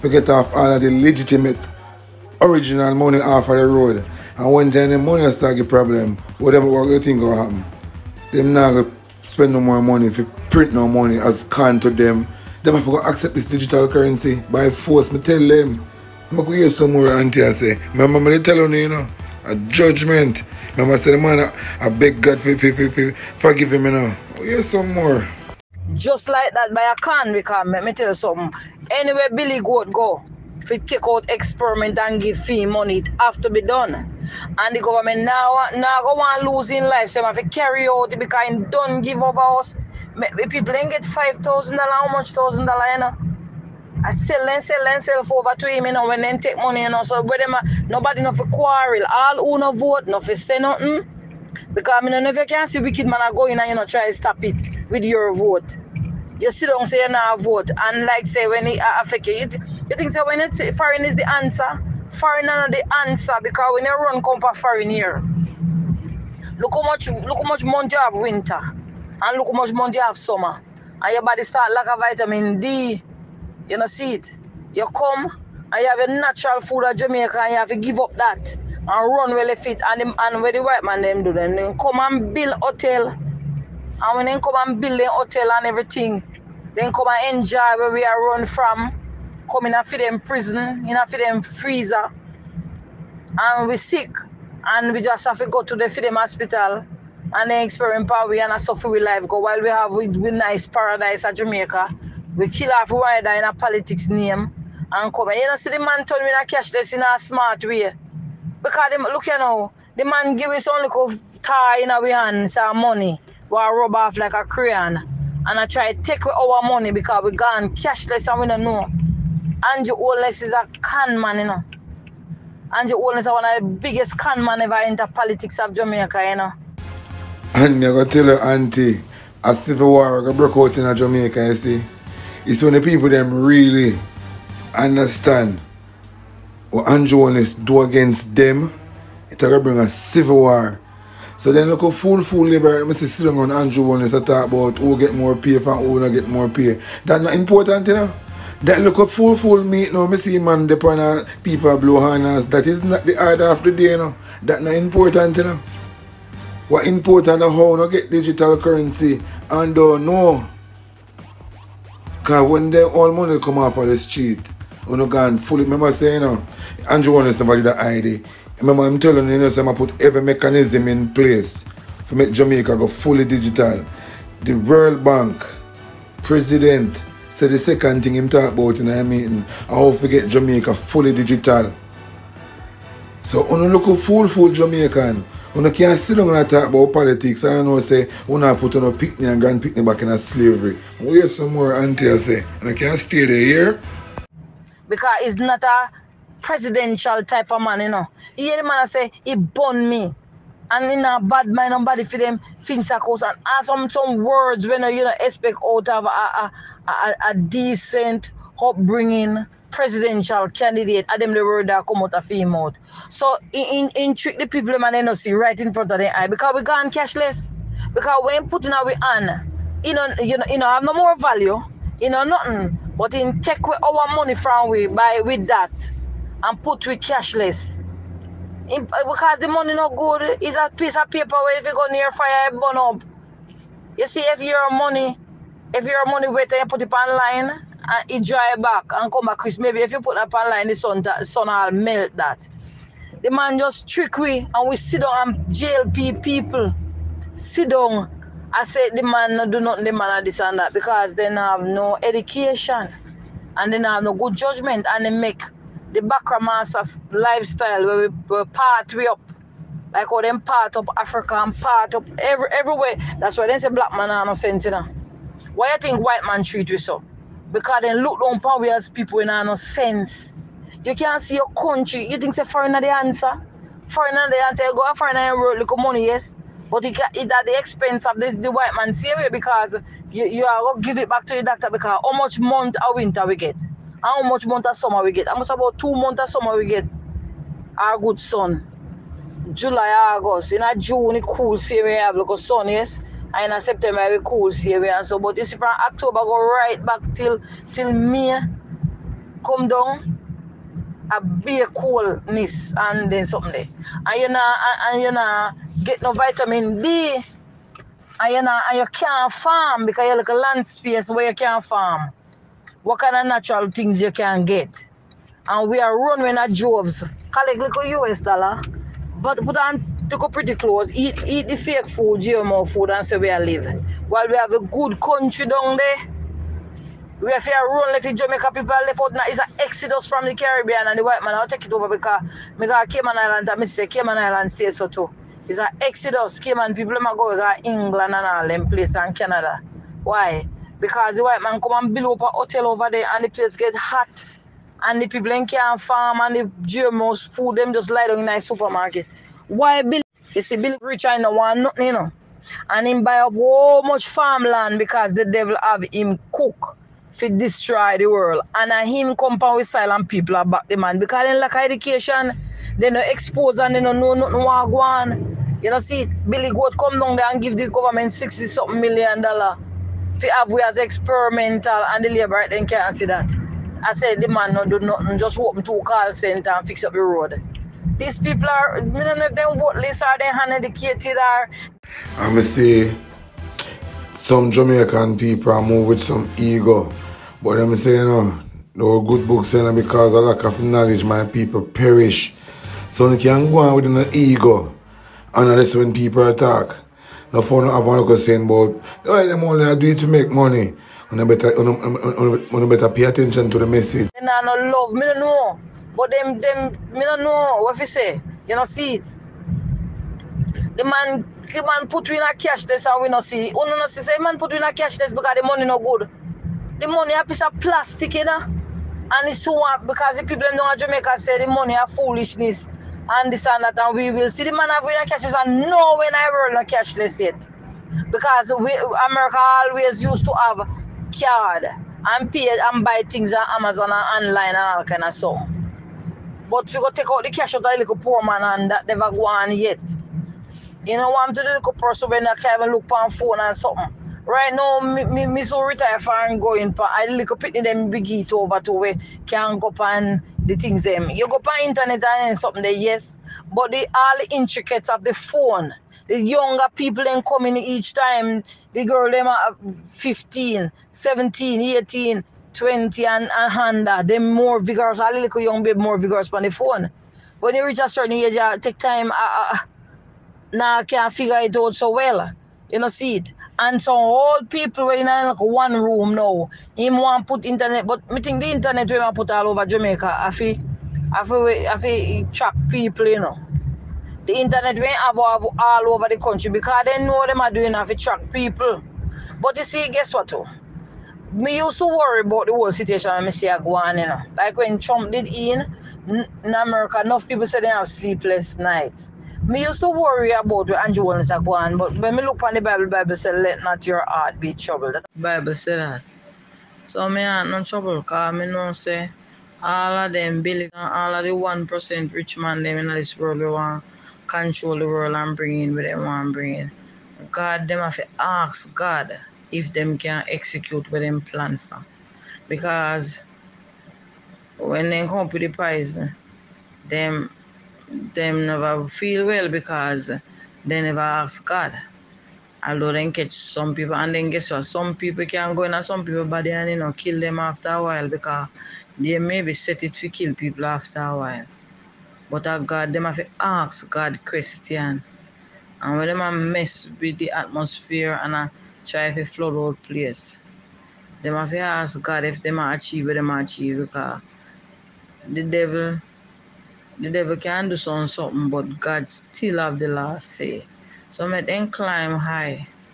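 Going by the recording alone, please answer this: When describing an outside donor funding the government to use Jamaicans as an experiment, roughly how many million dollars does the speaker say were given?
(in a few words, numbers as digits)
60 something million.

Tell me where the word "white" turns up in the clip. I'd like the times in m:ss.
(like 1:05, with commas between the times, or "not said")
1:20, 4:25, 4:38, 5:31, 5:41.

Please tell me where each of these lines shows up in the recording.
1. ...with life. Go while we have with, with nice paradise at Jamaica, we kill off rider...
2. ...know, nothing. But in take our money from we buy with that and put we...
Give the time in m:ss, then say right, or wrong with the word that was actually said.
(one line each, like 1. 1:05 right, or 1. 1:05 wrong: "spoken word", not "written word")
1. 1:38 right
2. 3:42 right.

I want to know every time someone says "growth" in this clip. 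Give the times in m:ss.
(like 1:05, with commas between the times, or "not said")
not said.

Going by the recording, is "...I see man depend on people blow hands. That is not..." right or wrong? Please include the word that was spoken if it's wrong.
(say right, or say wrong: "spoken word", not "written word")
right.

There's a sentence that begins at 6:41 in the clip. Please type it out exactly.
And better, better pay attention to the message.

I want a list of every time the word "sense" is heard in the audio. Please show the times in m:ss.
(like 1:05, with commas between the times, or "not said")
4:24, 4:29.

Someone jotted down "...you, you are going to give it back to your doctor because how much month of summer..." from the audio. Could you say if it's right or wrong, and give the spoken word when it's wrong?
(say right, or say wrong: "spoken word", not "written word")
wrong: "winter", not "summer".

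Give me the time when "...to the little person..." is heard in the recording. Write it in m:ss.
7:21.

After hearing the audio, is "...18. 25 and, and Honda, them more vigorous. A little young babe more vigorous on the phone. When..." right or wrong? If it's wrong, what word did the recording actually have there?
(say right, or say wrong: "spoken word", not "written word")
wrong: "20", not "25".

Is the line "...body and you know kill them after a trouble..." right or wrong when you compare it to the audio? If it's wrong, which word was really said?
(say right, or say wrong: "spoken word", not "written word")
wrong: "while", not "trouble".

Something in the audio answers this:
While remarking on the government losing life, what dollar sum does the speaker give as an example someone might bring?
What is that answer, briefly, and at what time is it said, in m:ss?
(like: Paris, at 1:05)
5,000 dollars, at 0:41.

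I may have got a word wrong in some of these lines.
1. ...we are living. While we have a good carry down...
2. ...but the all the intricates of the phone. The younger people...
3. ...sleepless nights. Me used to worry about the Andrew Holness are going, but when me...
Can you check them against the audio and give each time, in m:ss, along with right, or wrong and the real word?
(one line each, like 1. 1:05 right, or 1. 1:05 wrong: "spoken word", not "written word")
1. 5:23 wrong: "country", not "carry"
2. 7:33 right
3. 8:17 right.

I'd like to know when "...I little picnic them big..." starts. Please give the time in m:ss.
7:26.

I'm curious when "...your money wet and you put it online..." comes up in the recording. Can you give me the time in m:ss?
3:55.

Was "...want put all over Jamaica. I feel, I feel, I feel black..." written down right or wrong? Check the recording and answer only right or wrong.
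wrong.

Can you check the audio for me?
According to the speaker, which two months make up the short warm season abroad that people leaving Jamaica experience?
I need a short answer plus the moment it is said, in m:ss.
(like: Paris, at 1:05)
July, August, at 4:49.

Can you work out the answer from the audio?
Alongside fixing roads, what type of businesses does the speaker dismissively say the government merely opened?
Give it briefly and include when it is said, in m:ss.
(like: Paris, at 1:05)
call center, at 6:15.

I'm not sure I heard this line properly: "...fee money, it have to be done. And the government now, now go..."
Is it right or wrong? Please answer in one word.
right.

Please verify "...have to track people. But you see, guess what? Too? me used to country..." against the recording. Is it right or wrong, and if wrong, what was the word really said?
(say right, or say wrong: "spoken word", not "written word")
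wrong: "worry", not "country".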